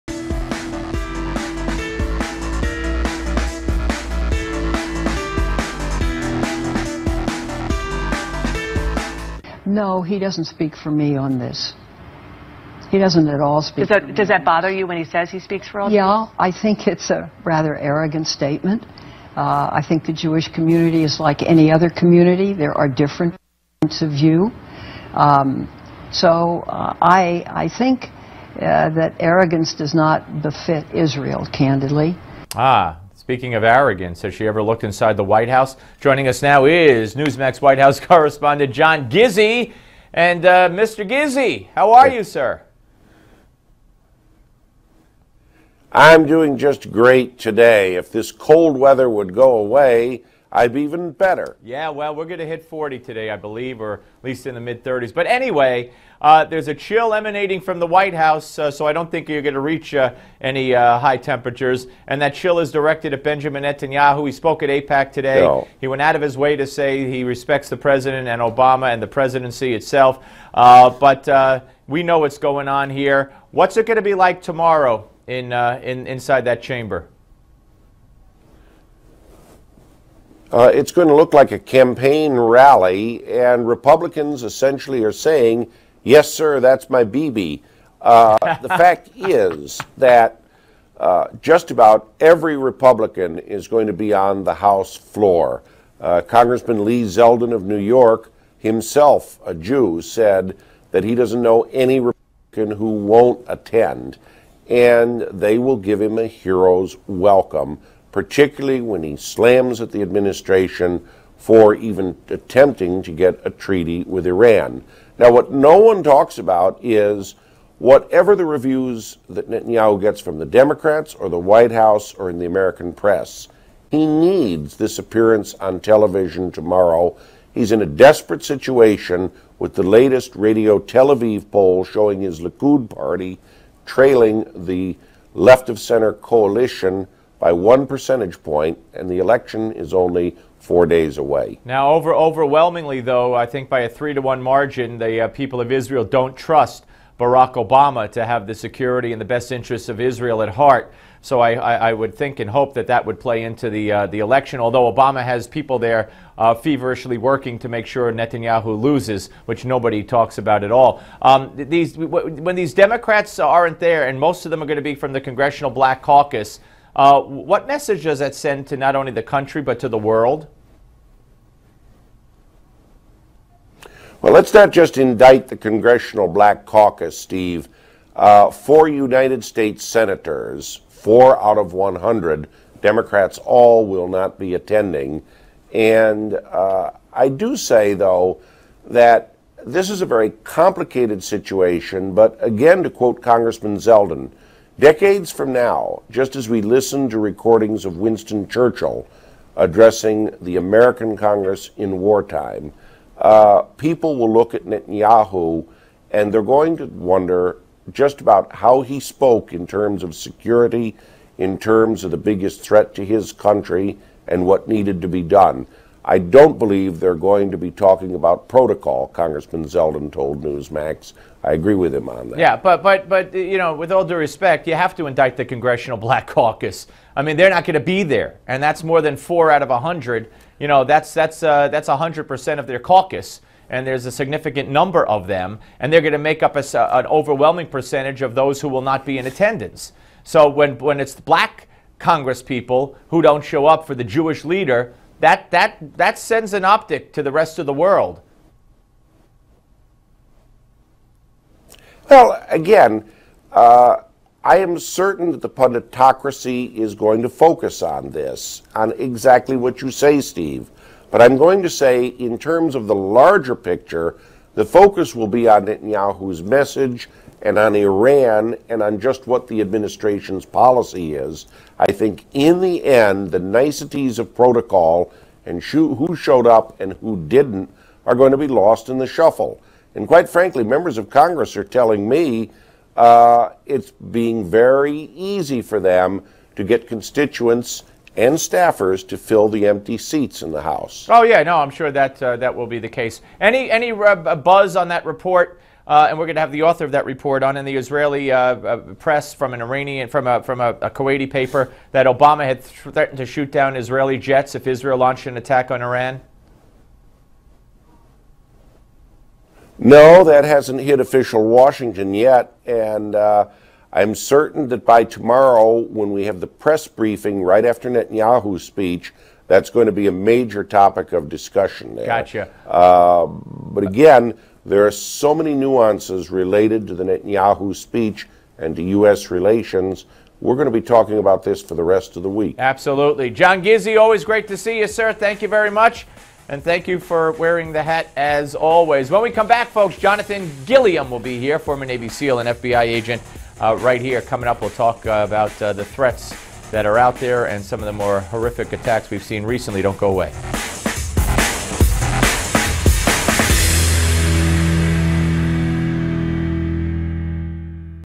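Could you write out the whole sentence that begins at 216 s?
I don't believe they're going to be talking about protocol.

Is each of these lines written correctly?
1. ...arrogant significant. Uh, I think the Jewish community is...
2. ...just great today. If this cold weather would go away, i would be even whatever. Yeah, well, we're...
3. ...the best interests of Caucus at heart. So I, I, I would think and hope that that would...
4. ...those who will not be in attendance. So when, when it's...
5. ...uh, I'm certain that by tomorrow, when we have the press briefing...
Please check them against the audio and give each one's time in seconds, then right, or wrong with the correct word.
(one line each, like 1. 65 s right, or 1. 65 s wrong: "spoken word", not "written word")
1. 17 s wrong: "statement", not "significant"
2. 46 s wrong: "better", not "whatever"
3. 149 s wrong: "Israel", not "Caucus"
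4. 238 s right
5. 313 s right.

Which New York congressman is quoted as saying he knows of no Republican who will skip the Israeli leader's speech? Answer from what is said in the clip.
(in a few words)
Lee Zeldin.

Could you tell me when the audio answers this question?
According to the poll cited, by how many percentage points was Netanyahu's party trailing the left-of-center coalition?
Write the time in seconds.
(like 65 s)
137 s.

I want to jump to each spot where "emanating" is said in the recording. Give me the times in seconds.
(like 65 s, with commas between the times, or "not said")
57 s.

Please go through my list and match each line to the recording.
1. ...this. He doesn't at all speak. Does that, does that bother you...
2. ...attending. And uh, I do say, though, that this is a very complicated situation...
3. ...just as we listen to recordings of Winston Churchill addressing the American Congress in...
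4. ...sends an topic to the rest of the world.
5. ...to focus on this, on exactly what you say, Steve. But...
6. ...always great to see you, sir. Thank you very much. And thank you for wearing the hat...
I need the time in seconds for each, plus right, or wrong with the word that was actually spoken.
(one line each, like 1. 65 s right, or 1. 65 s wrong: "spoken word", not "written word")
1. 11 s right
2. 184 s right
3. 196 s right
4. 246 s wrong: "optic", not "topic"
5. 257 s right
6. 333 s right.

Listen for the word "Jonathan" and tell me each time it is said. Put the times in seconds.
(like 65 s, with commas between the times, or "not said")
339 s.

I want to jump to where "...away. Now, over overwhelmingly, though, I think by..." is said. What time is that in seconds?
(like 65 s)
141 s.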